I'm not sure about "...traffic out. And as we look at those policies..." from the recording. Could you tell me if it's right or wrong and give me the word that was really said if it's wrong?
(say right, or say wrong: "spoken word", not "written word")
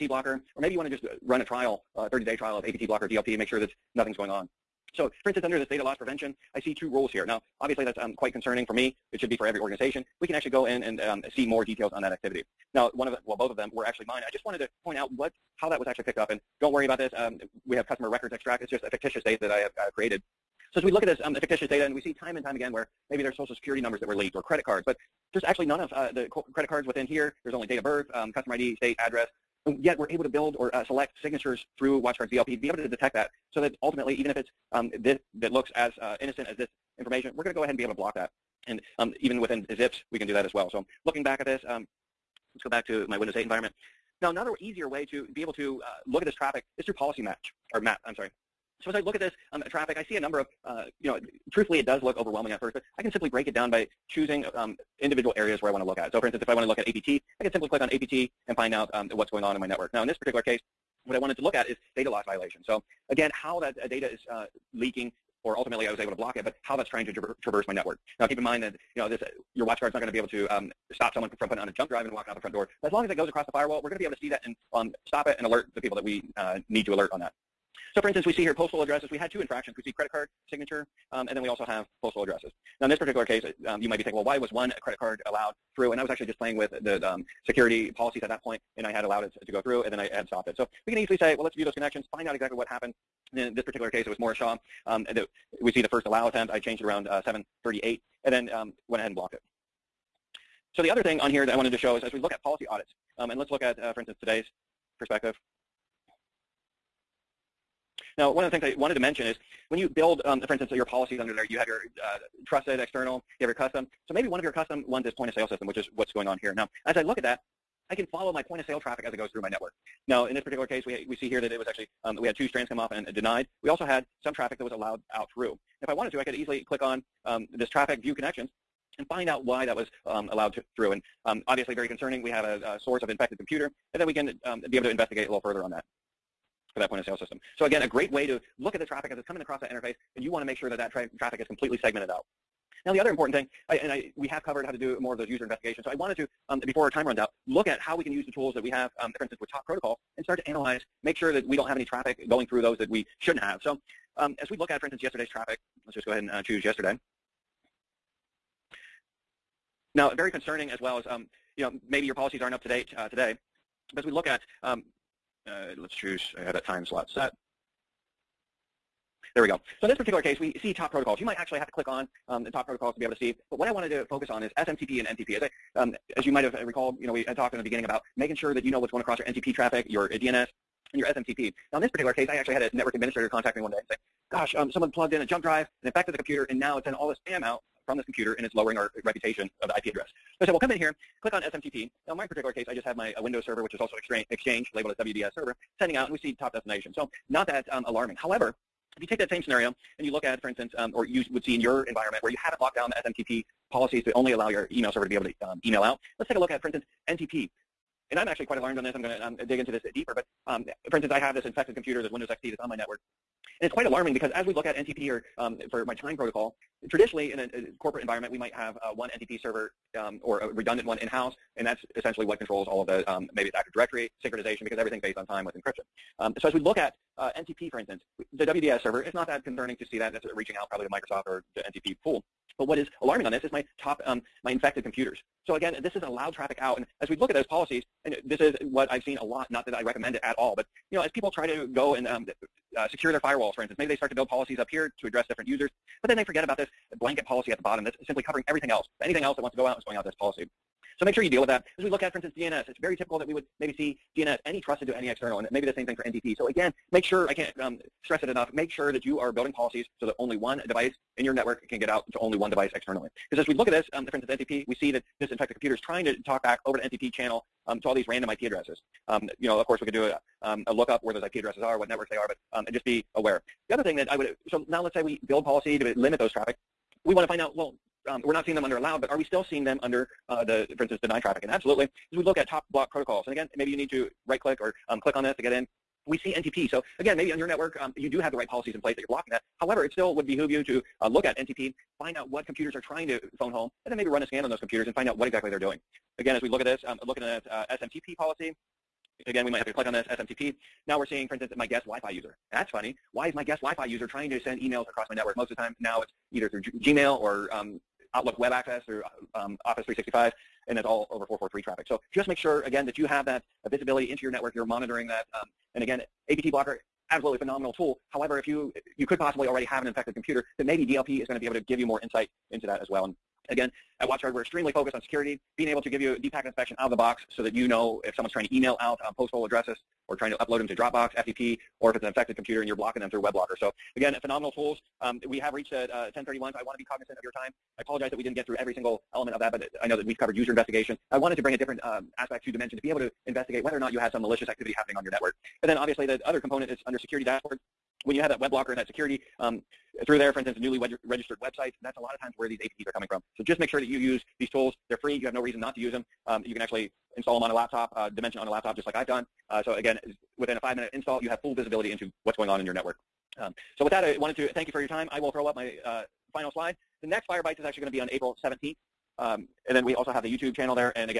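right.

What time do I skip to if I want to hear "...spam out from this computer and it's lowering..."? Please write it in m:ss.
3:07.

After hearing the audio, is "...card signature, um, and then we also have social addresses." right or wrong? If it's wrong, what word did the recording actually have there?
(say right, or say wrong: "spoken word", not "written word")
wrong: "postal", not "social".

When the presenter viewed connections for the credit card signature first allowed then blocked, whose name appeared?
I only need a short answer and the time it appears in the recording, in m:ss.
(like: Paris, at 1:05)
Morris Shaw, at 1:34.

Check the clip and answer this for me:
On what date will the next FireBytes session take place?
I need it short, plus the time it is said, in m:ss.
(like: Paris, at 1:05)
April 17th, at 6:08.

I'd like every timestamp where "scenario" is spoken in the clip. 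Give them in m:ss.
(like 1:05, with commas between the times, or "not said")
3:19.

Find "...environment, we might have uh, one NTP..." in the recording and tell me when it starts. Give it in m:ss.
3:38.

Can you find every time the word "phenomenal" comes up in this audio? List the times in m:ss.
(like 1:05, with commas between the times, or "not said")
5:17, 5:34.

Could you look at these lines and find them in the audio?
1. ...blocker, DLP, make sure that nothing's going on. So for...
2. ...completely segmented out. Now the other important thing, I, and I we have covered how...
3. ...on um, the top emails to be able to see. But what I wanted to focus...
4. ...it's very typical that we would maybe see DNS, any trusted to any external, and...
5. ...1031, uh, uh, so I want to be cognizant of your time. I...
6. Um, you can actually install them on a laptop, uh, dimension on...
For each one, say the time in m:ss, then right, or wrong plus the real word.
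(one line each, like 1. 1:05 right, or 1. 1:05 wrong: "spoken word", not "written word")
1. 0:02 right
2. 2:21 right
3. 2:51 wrong: "protocols", not "emails"
4. 4:12 right
5. 5:35 right
6. 5:56 right.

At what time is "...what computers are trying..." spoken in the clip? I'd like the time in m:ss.
4:52.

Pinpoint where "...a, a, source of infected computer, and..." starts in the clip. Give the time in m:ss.
2:12.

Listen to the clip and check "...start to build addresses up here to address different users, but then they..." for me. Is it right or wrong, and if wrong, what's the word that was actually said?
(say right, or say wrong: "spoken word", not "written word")
wrong: "policies", not "addresses".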